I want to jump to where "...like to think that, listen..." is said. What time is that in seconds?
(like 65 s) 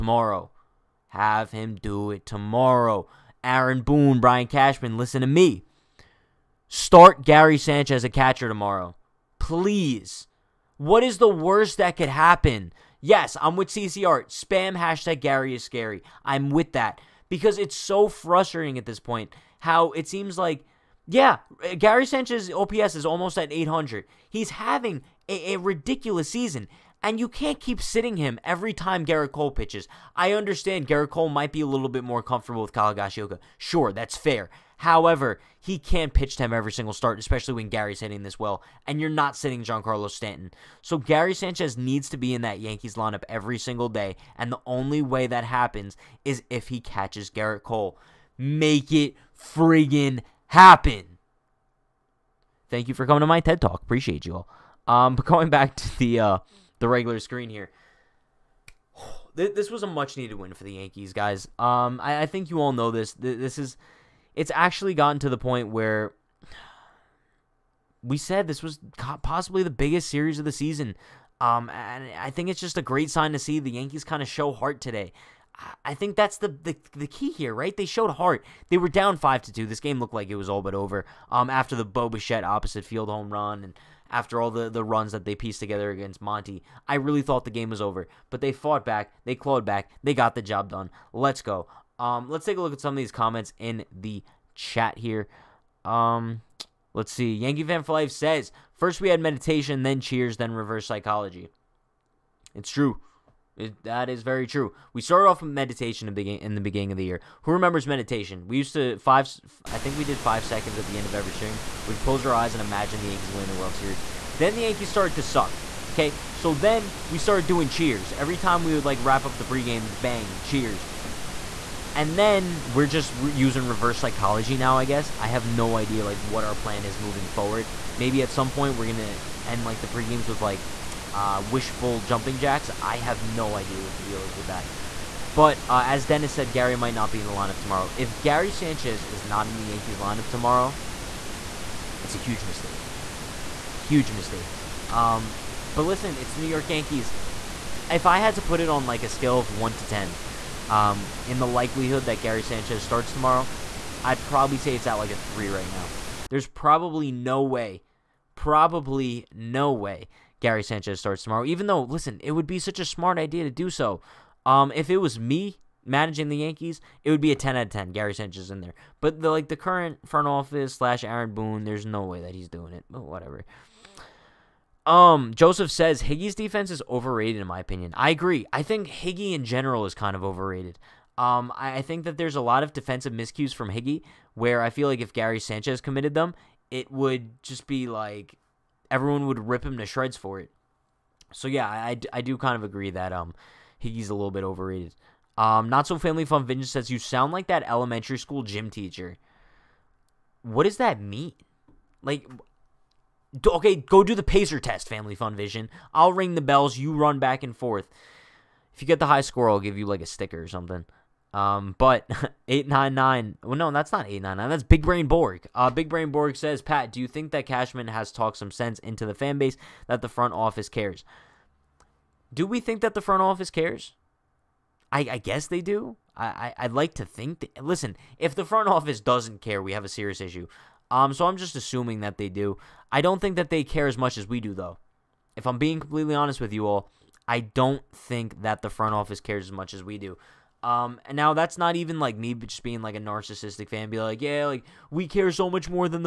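226 s.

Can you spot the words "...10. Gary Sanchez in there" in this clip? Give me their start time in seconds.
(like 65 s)
167 s.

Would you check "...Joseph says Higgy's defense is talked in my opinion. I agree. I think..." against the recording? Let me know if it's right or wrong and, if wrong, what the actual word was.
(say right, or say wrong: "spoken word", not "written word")
wrong: "overrated", not "talked".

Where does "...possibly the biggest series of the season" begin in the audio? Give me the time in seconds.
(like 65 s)
69 s.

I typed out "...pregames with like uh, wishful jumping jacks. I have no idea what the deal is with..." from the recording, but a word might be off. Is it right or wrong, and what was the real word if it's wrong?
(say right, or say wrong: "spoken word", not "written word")
right.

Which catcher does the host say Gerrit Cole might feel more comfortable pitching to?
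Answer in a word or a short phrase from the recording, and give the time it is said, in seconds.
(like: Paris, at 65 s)
Kyle Higashioka, at 32 s.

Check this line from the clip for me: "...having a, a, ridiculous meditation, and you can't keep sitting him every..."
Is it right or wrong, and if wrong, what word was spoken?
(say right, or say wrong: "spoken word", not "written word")
wrong: "season", not "meditation".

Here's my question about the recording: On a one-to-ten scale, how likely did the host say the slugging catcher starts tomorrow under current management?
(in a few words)
3.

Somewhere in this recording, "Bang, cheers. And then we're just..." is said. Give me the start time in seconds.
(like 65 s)
120 s.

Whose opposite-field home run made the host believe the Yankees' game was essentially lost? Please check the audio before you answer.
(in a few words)
Bo Bichette.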